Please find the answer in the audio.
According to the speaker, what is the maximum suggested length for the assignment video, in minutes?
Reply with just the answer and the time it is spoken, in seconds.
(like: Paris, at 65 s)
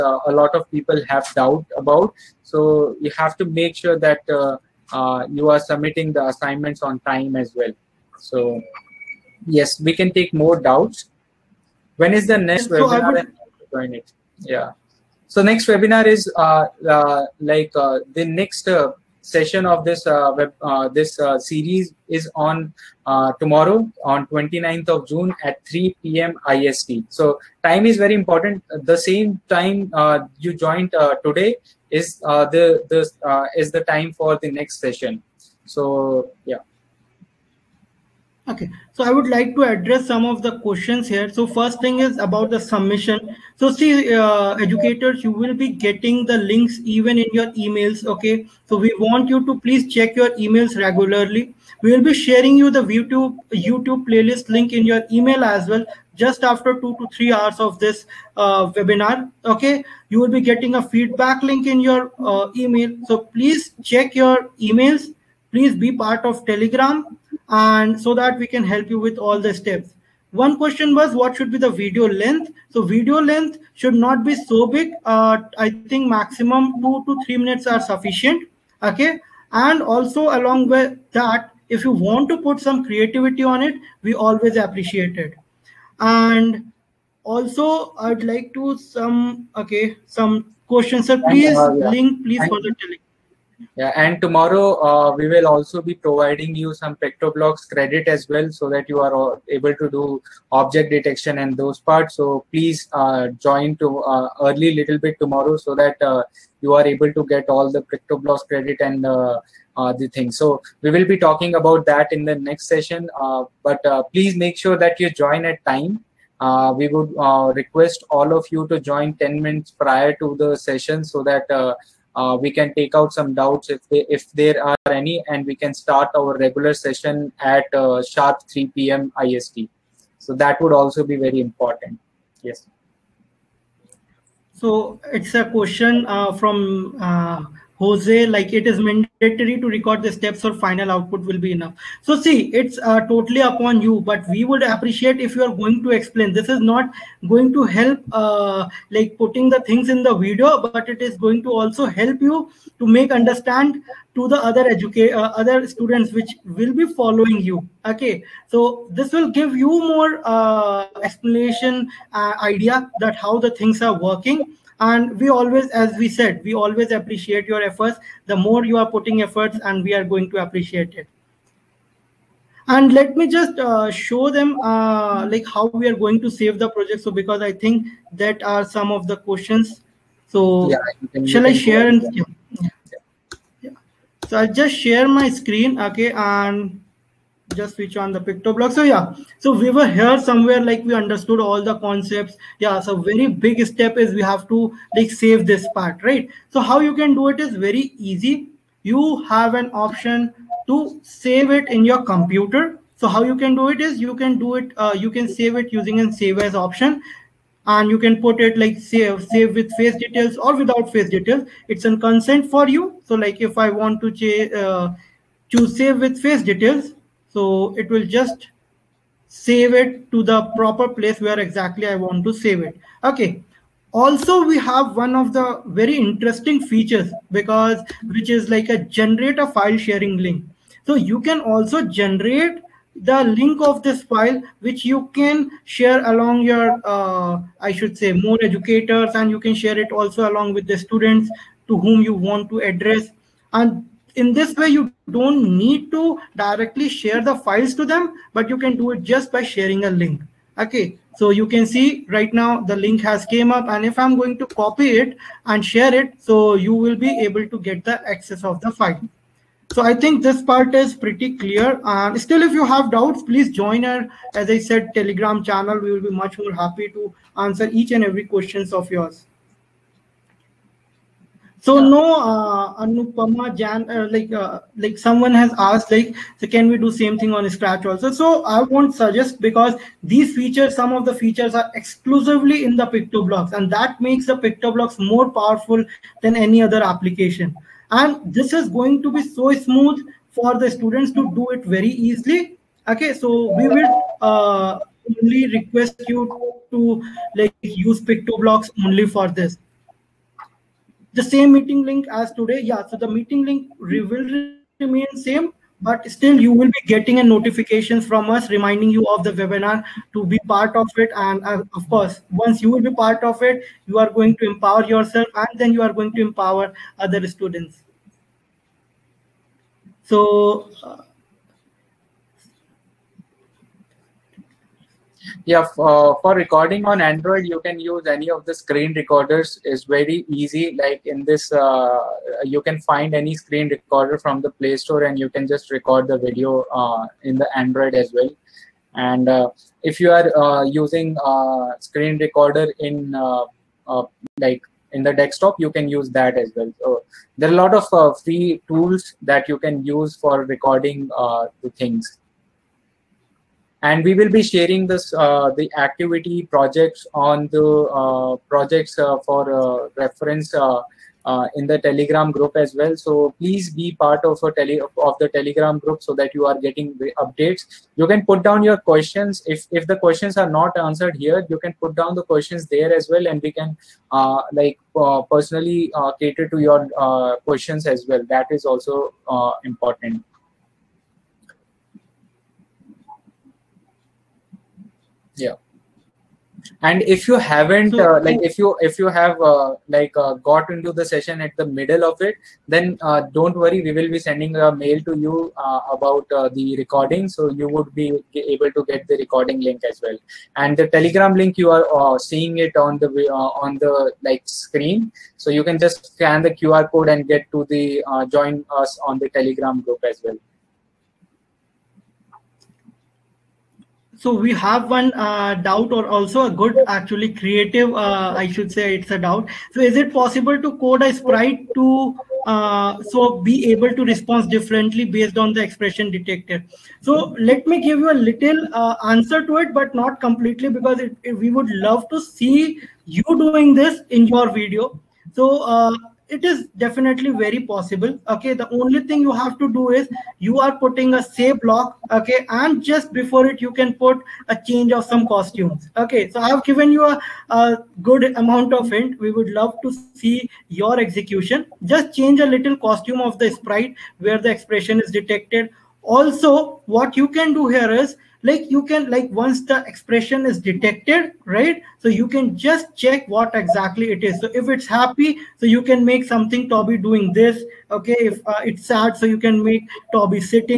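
2 to 3 minutes, at 76 s.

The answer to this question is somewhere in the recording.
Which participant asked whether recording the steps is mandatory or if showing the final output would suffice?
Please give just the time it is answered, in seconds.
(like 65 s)
137 s.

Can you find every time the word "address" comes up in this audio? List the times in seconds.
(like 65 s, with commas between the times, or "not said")
39 s, 242 s.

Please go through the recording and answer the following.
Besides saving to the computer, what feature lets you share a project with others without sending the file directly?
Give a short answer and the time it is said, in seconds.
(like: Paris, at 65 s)
File sharing link, at 229 s.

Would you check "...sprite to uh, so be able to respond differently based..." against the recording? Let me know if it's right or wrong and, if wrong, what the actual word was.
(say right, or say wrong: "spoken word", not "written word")
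right.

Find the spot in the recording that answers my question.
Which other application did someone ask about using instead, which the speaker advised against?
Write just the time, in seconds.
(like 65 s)
277 s.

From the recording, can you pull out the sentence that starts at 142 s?
So see, it's uh, totally upon you, but we would appreciate if you are going to explain.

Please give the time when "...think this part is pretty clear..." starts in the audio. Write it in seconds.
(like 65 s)
259 s.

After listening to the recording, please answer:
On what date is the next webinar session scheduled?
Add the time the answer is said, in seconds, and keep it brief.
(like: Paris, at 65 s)
29th of June, at 24 s.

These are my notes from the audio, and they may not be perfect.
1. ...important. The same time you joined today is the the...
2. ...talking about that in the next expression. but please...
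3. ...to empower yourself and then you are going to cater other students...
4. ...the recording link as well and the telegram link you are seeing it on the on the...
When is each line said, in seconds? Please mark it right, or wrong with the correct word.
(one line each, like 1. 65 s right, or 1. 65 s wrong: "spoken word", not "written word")
1. 28 s right
2. 111 s wrong: "session", not "expression"
3. 314 s wrong: "empower", not "cater"
4. 399 s right.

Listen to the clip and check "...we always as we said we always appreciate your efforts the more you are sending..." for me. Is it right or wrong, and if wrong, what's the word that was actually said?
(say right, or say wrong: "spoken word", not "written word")
wrong: "putting", not "sending".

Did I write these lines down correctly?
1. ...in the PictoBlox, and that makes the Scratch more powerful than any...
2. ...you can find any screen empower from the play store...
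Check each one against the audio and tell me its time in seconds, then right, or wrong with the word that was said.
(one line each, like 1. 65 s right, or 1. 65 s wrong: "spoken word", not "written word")
1. 282 s wrong: "PictoBlox", not "Scratch"
2. 332 s wrong: "recorder", not "empower".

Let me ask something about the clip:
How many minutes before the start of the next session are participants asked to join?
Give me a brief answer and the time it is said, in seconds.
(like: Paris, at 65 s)
10, at 119 s.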